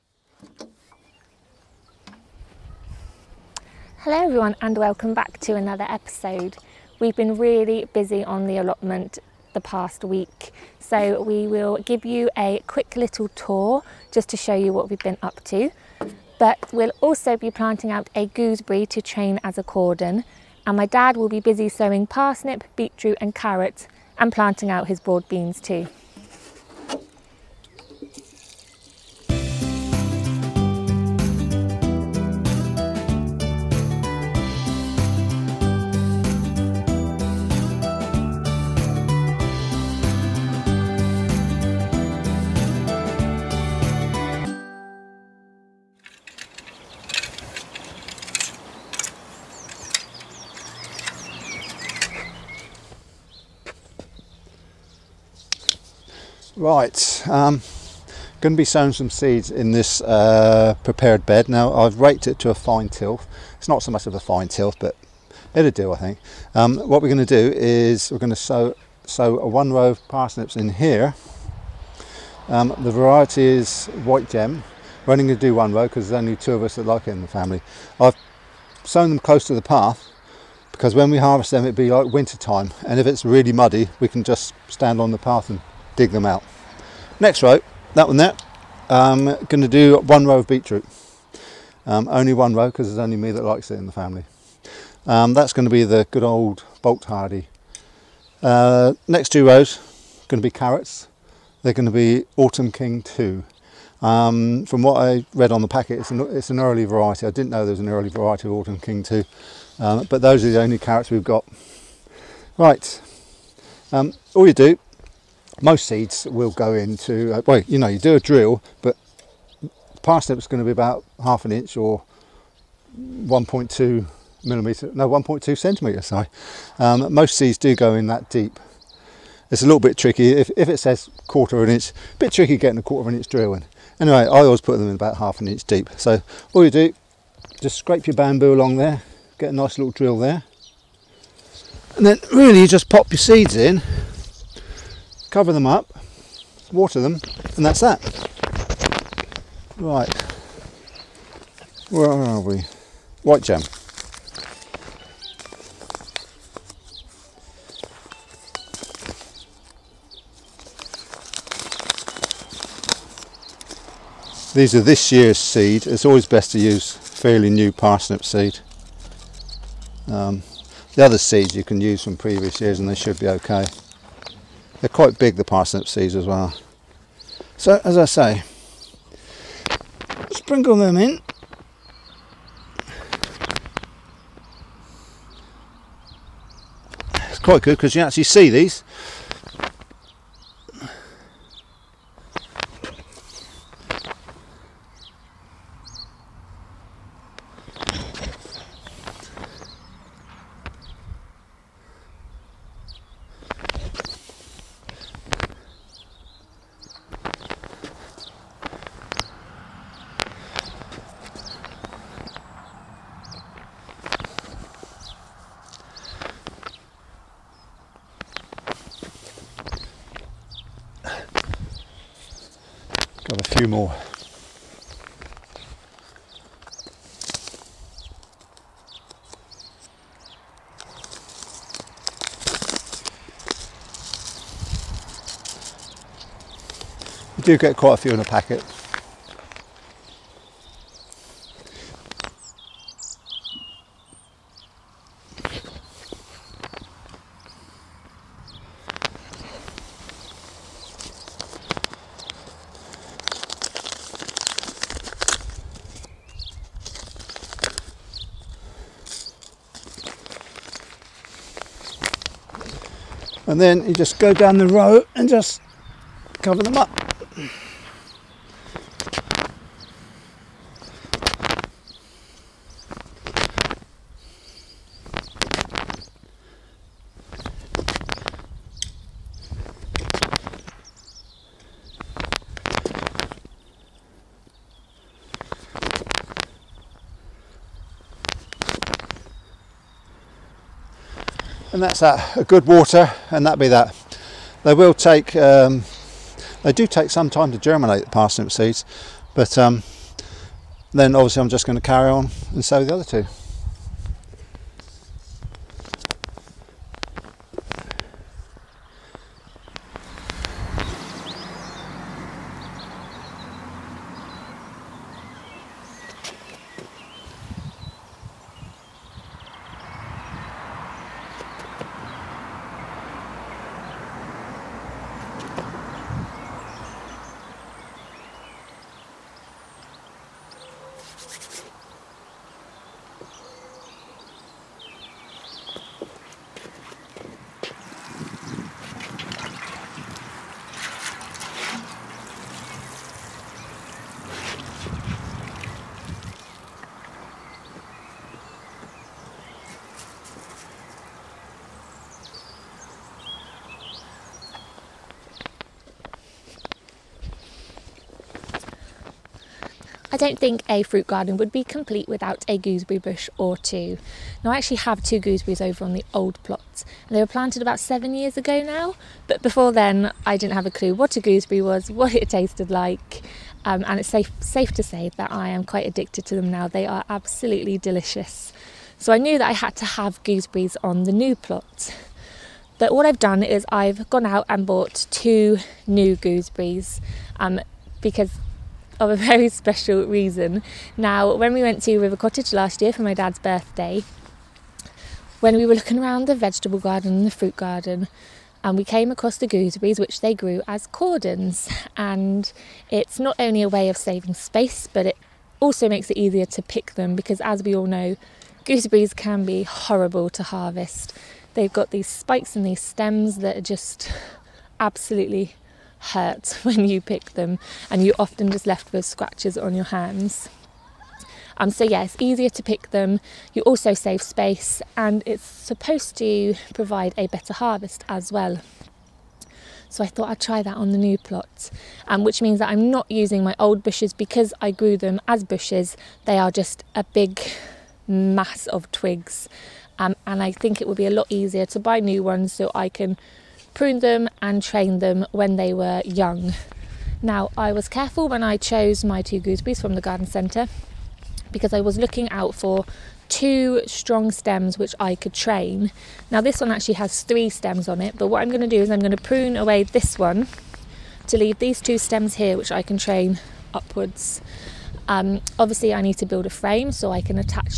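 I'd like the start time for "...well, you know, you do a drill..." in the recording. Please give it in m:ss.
1:57.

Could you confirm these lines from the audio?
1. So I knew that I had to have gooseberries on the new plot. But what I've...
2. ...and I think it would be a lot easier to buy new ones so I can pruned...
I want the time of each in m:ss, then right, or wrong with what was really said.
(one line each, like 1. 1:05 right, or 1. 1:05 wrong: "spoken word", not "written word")
1. 6:18 right
2. 7:20 right.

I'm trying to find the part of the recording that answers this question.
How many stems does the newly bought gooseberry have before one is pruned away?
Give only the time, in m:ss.
7:37.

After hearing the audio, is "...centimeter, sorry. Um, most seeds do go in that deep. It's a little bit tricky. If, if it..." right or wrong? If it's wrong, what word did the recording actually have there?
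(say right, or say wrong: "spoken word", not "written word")
right.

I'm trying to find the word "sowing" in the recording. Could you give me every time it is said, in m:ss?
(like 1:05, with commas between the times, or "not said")
0:21, 0:58.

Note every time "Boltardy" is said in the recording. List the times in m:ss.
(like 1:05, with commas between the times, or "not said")
1:36.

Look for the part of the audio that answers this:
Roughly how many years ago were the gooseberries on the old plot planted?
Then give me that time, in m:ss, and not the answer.
6:07.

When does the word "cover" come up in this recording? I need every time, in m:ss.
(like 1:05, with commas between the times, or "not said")
2:25, 4:26.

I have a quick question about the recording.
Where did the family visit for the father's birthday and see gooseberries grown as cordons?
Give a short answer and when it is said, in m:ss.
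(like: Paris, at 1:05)
River Cottage, at 6:31.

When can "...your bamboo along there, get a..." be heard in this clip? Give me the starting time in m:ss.
2:18.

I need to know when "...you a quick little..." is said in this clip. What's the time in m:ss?
0:12.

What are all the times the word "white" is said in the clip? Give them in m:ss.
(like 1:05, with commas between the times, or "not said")
1:14, 2:33.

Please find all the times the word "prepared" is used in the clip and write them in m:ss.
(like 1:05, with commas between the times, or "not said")
1:00.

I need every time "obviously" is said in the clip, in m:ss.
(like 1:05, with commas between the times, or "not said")
5:01, 7:45.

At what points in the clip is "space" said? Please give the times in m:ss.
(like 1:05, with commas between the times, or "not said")
6:44, 7:04.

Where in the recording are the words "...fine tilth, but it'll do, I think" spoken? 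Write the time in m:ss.
1:04.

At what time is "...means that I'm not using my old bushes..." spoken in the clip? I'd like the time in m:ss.
7:12.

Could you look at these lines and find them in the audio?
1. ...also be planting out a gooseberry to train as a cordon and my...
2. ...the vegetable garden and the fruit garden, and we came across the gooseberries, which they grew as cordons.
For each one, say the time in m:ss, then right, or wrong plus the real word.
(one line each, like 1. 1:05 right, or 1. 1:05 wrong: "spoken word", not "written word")
1. 0:17 right
2. 6:36 right.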